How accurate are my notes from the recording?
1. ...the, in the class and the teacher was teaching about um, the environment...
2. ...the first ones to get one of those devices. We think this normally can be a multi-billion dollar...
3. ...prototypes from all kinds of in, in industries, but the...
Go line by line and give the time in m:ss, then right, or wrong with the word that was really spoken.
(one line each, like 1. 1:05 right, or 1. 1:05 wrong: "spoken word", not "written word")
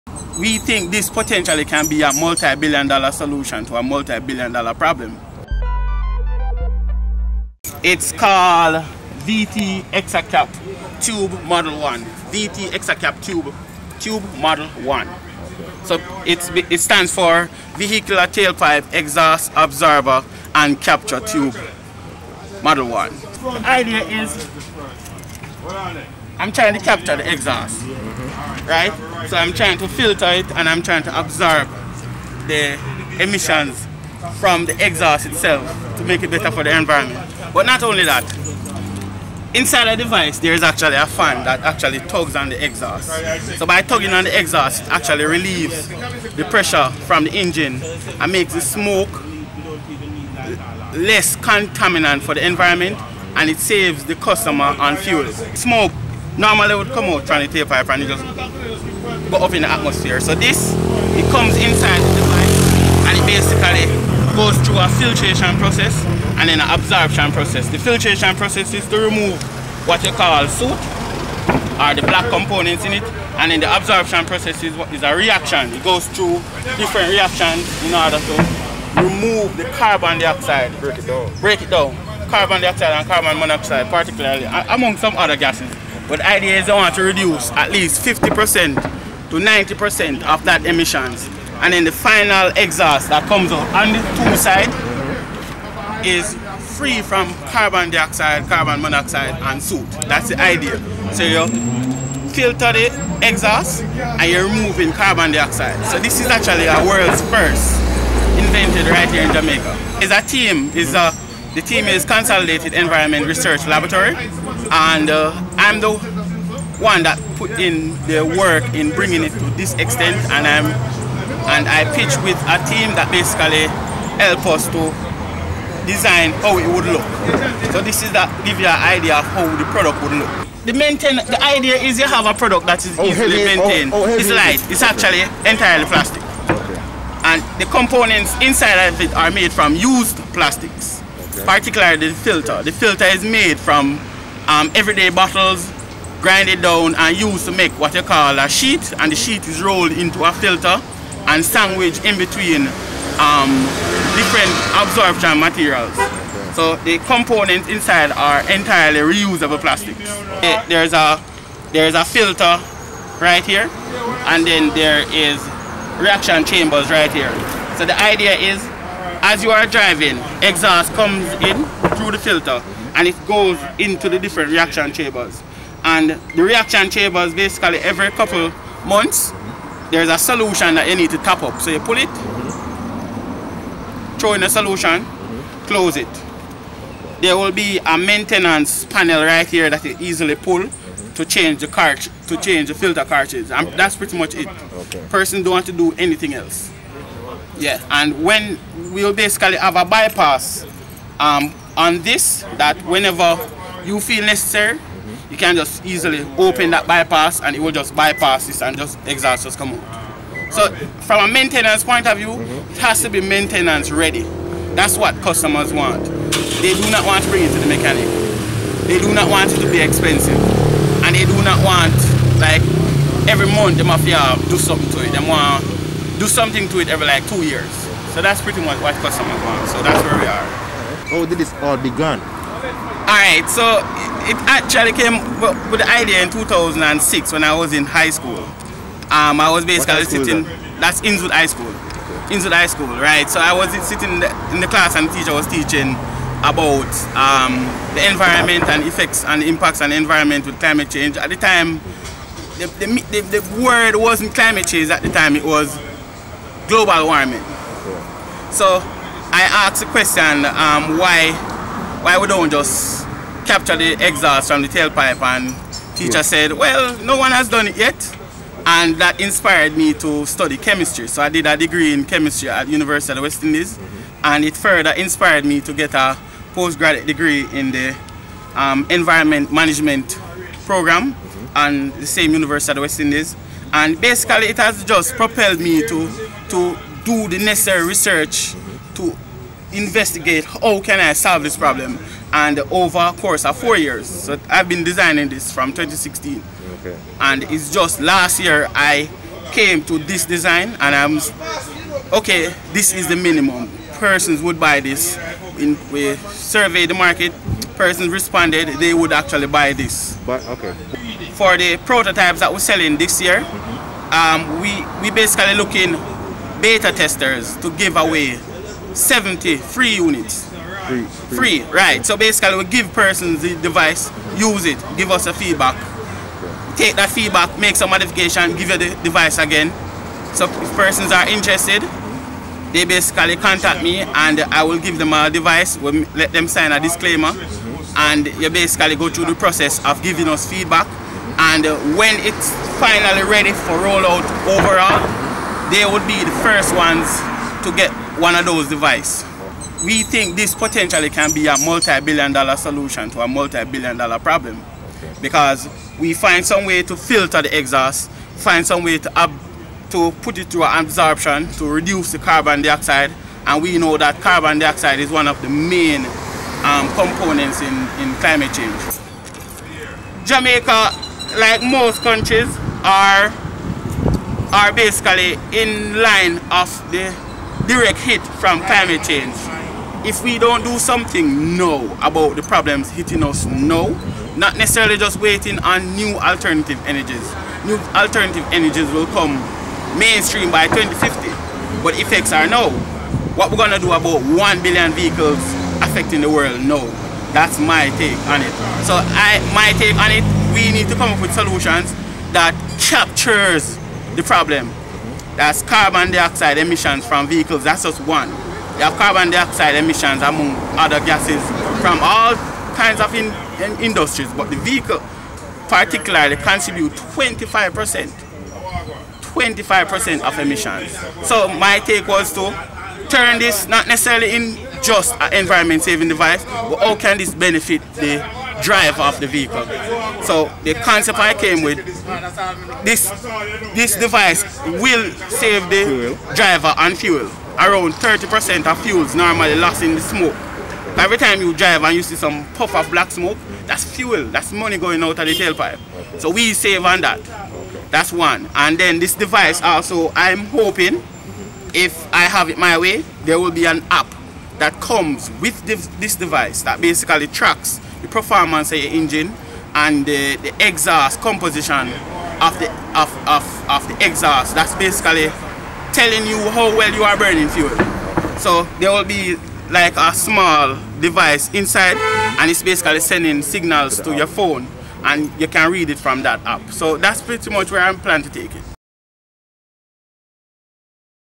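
1. 4:04 right
2. 5:46 wrong: "potentially", not "normally"
3. 6:51 wrong: "gases", not "prototypes".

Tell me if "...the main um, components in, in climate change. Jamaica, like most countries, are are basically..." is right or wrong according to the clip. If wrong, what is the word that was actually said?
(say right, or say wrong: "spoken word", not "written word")
right.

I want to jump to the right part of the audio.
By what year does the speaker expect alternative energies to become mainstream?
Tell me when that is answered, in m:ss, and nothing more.
6:30.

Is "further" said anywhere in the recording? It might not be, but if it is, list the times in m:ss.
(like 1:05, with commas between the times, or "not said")
4:34.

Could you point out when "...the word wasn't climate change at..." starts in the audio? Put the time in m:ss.
4:13.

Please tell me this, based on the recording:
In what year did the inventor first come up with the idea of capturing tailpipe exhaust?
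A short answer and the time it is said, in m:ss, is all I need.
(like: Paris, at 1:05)
2006, at 3:56.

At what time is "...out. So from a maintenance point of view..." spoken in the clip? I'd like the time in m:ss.
3:29.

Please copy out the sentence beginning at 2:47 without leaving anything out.
So the idea is as you are driving, exhaust comes in through the filter and it goes into the different reaction chambers.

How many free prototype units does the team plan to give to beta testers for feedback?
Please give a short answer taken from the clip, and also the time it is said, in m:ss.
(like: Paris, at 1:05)
70, at 5:18.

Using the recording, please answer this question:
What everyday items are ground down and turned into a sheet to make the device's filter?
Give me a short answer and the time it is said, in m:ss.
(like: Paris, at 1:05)
bottles, at 2:25.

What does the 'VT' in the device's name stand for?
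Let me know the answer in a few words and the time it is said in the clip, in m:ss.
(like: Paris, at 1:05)
Vehicular Tailpipe, at 0:17.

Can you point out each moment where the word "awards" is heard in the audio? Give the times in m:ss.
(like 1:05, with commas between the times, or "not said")
not said.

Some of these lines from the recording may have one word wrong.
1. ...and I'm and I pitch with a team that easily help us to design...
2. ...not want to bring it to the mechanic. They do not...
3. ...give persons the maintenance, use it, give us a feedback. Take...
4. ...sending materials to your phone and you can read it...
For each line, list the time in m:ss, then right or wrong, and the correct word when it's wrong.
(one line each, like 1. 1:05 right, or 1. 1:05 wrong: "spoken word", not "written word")
1. 2:00 wrong: "basically", not "easily"
2. 3:36 right
3. 5:22 wrong: "device", not "maintenance"
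4. 7:52 wrong: "signals", not "materials".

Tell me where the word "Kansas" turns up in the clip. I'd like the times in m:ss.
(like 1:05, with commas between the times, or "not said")
not said.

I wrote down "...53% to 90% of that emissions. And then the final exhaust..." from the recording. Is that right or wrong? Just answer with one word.
wrong.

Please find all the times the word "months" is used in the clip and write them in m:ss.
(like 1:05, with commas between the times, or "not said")
2:58, 3:43.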